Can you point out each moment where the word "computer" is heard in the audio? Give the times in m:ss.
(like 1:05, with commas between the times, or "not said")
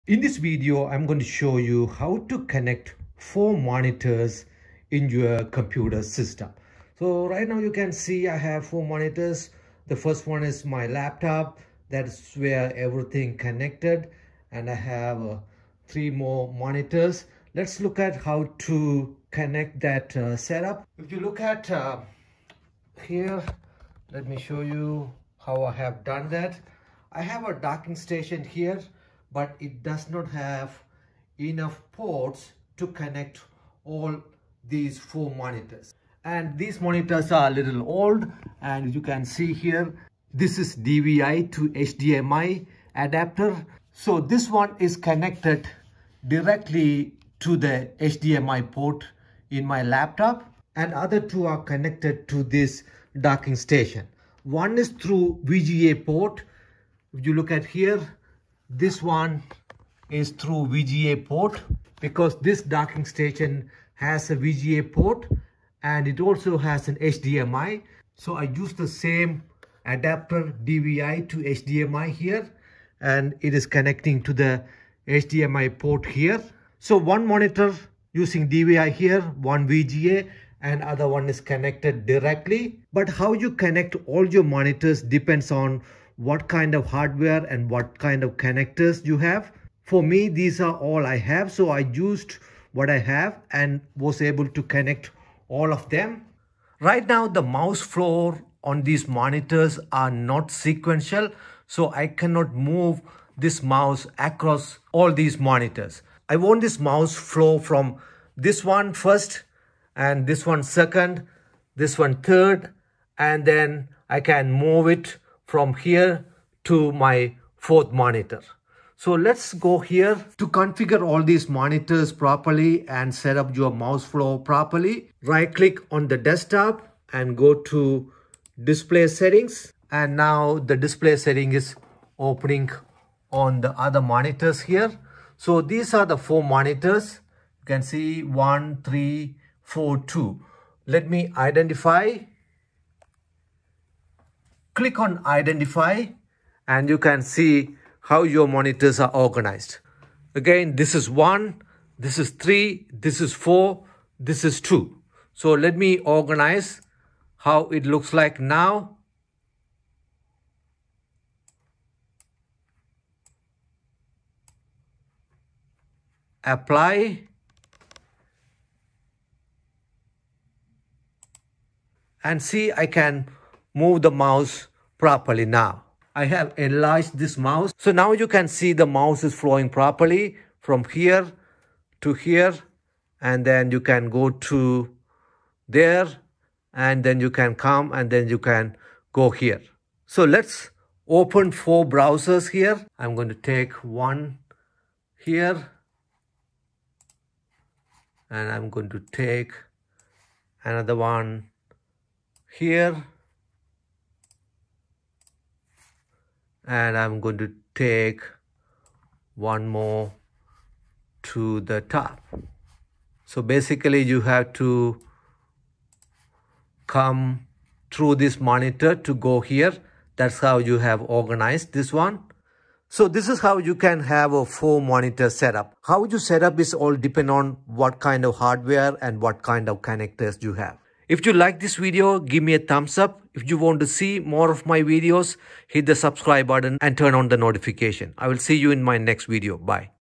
0:05.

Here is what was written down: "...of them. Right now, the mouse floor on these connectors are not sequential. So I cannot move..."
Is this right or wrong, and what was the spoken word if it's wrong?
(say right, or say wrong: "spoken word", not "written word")
wrong: "monitors", not "connectors".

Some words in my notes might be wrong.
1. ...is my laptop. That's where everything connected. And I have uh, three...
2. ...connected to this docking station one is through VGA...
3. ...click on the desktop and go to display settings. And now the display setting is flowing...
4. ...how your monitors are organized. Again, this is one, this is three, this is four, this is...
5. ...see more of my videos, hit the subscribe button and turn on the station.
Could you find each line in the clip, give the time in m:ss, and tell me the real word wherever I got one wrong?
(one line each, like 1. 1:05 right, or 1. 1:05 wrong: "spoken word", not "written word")
1. 0:10 right
2. 0:51 right
3. 2:05 wrong: "opening", not "flowing"
4. 2:28 right
5. 3:53 wrong: "notification", not "station".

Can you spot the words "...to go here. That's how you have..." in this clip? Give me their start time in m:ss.
3:38.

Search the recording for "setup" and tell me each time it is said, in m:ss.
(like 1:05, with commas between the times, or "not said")
0:20, 3:45.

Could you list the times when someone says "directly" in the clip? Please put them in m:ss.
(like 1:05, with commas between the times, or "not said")
0:46, 1:22.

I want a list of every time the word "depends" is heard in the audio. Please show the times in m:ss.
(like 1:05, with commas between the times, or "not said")
1:25, 3:46.